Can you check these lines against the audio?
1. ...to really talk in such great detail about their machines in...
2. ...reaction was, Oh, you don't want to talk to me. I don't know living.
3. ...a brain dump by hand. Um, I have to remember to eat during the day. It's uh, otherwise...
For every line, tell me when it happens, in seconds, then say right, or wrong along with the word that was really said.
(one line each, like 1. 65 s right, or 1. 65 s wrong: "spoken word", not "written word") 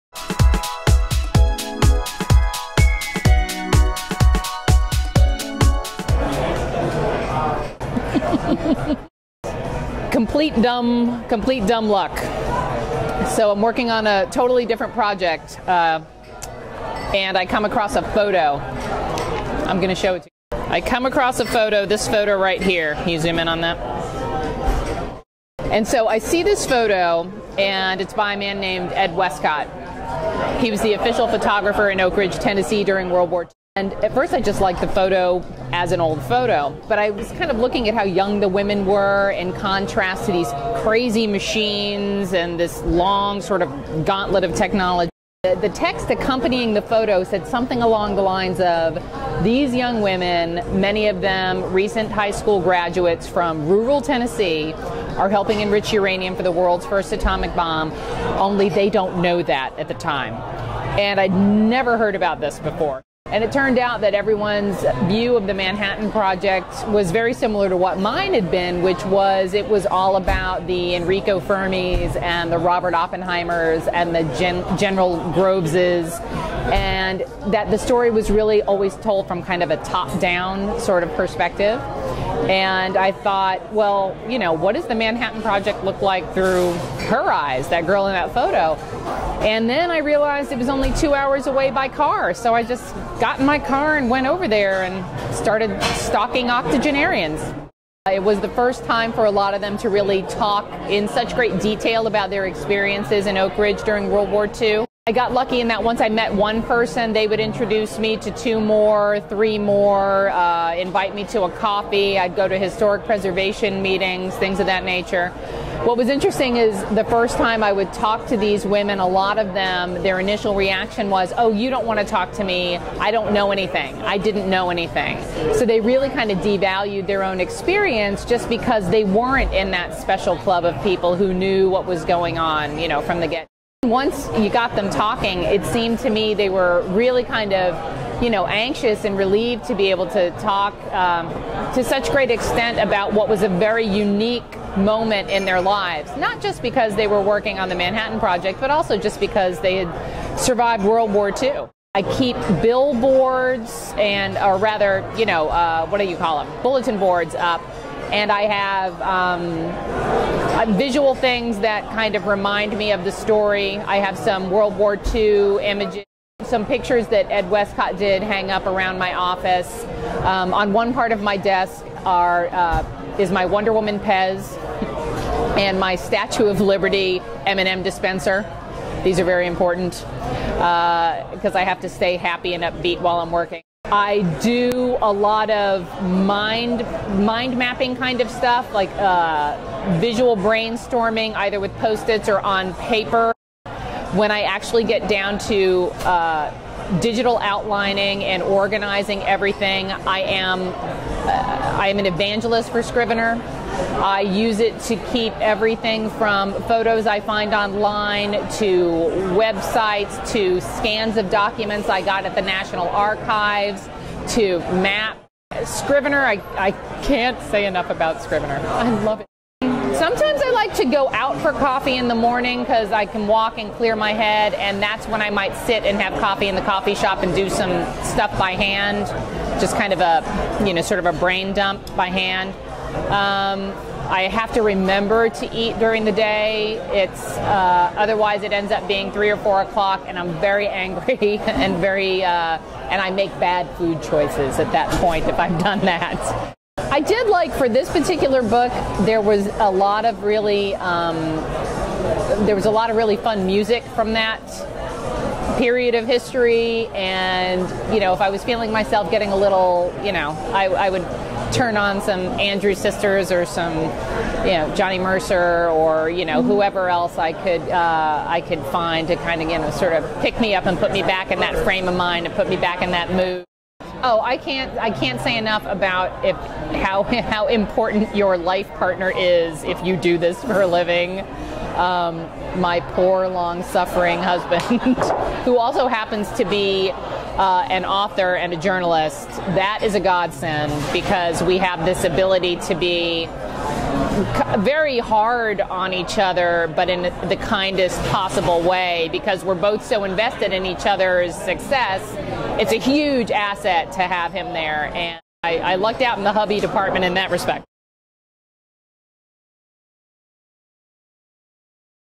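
1. 99 s wrong: "experiences", not "machines"
2. 120 s wrong: "anything", not "living"
3. 231 s right.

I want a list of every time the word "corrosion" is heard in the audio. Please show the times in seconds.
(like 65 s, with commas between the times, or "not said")
not said.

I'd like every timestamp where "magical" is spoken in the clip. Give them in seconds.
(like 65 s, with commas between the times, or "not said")
not said.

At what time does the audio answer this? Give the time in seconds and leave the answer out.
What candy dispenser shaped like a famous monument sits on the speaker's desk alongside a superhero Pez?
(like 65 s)
175 s.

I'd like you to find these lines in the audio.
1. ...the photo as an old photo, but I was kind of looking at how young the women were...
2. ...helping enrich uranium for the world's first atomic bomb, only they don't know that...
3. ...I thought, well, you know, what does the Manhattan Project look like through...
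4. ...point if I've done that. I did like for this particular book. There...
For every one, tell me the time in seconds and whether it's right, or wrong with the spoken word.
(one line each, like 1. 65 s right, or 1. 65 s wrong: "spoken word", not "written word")
1. 34 s right
2. 55 s right
3. 82 s right
4. 244 s right.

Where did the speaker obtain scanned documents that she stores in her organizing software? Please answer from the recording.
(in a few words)
National Archives.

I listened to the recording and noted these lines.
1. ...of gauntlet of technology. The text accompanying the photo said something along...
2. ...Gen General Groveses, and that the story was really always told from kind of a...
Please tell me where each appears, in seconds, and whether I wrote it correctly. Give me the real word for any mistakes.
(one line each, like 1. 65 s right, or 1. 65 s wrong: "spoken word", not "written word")
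1. 43 s right
2. 74 s right.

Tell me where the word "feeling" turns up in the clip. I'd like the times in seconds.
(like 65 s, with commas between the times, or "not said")
258 s.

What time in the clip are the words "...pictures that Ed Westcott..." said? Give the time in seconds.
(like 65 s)
166 s.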